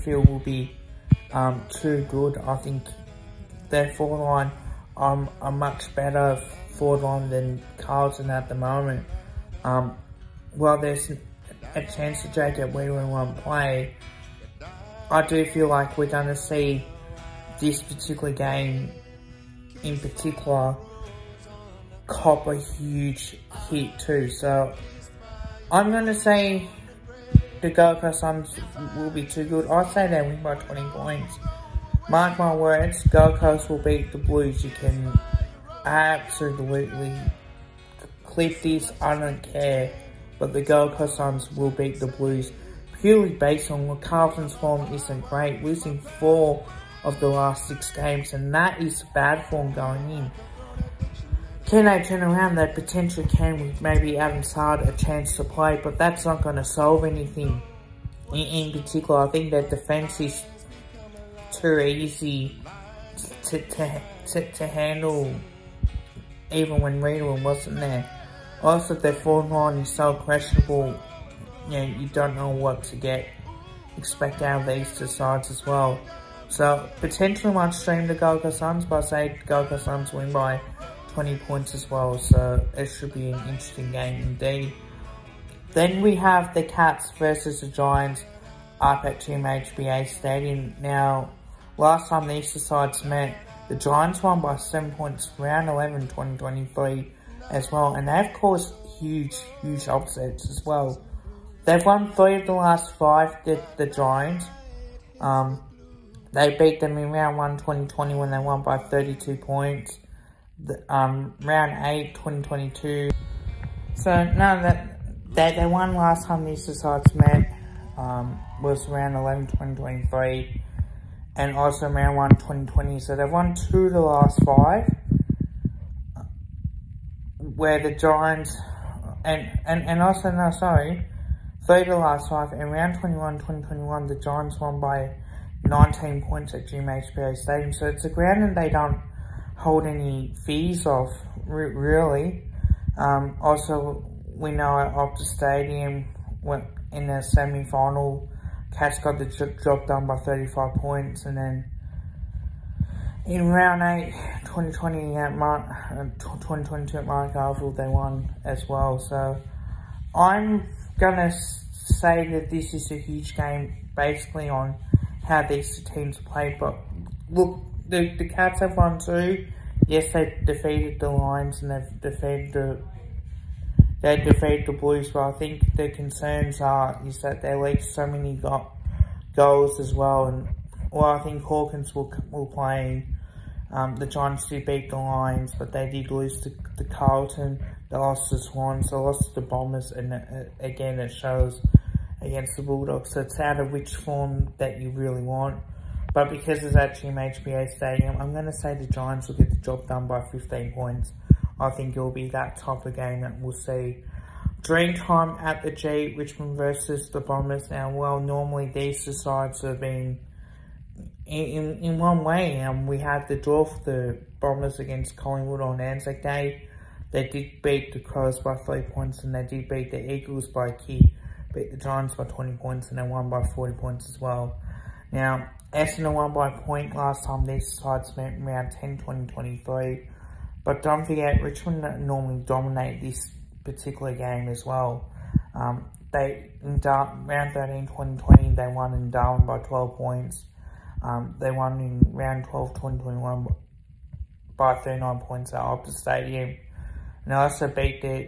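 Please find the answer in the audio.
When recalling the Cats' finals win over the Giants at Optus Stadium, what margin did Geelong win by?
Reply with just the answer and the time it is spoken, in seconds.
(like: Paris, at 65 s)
35 points, at 150 s.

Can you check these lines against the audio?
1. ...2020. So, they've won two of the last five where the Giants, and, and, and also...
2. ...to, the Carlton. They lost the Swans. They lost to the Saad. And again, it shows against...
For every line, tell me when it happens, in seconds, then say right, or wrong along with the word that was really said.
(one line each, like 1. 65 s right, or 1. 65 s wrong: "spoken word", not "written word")
1. 122 s right
2. 186 s wrong: "Bombers", not "Saad".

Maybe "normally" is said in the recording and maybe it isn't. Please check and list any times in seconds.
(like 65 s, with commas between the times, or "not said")
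208 s, 232 s.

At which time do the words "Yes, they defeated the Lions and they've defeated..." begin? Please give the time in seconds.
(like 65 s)
169 s.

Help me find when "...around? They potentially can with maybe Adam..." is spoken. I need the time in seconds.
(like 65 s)
52 s.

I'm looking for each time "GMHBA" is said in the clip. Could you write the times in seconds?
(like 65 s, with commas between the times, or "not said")
89 s, 136 s, 197 s.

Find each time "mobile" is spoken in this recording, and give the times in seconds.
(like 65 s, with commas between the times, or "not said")
not said.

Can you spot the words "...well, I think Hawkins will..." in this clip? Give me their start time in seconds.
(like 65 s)
180 s.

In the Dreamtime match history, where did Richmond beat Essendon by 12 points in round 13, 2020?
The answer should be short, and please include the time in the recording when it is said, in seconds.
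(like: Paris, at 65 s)
Darwin, at 239 s.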